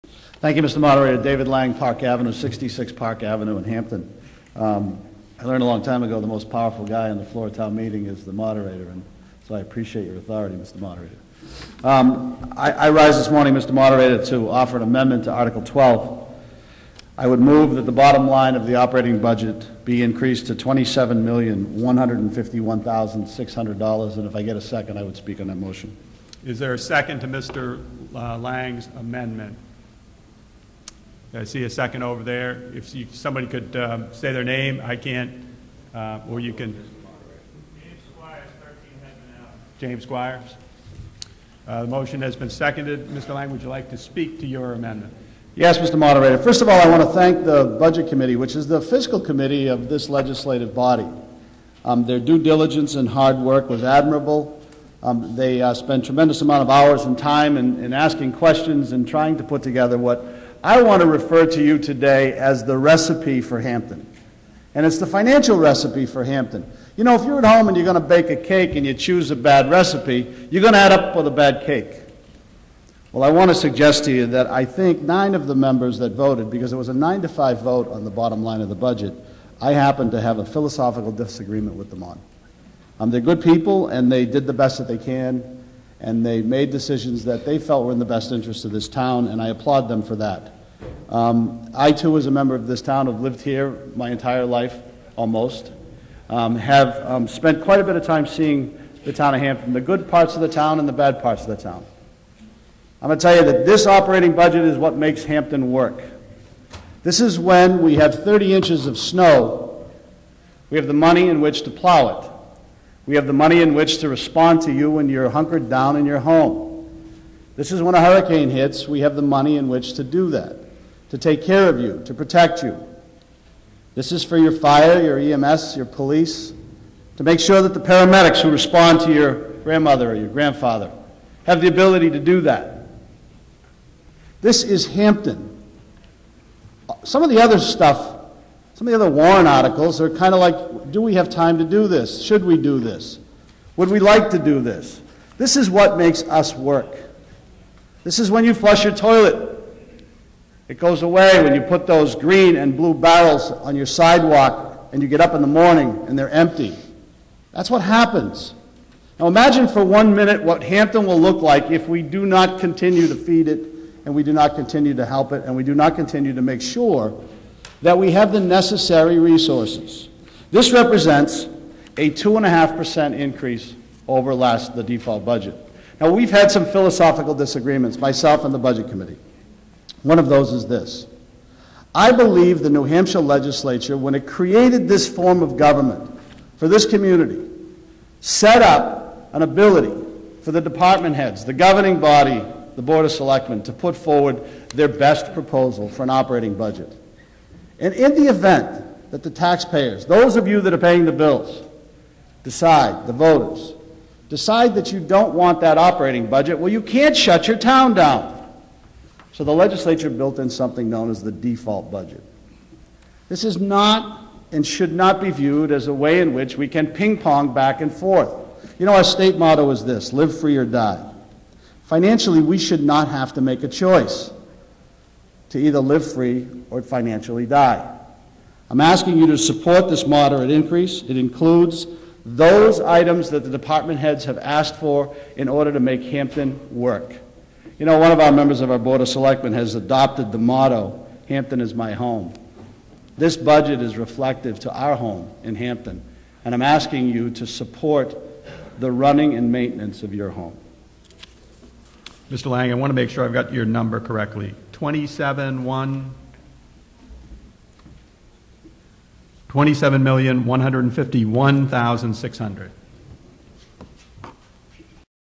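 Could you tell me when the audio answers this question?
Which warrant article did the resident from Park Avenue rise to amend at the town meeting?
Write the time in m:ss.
0:15.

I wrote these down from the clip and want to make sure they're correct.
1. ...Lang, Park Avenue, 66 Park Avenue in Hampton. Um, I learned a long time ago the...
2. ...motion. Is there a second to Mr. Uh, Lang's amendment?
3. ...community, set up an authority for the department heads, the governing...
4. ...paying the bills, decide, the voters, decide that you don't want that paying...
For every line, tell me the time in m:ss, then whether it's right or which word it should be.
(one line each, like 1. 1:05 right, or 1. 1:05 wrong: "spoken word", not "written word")
1. 0:01 right
2. 0:25 right
3. 3:06 wrong: "ability", not "authority"
4. 3:20 wrong: "operating", not "paying".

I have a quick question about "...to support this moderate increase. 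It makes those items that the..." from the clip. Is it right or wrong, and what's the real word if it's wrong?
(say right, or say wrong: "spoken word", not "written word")
wrong: "includes", not "makes".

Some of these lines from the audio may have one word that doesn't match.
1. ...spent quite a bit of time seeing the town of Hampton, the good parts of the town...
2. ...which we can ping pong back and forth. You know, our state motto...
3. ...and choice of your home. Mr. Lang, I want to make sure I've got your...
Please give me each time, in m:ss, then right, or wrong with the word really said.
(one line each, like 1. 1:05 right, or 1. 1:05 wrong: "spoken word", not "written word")
1. 1:37 right
2. 3:36 right
3. 4:09 wrong: "maintenance", not "choice".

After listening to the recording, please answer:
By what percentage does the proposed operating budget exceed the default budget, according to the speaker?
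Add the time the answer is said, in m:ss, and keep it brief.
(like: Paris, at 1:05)
2.5%, at 2:52.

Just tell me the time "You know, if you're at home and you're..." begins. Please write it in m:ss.
1:06.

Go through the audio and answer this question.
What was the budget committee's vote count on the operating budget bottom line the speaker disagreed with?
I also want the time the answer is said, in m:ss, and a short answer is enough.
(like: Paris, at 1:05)
9 to 5, at 1:16.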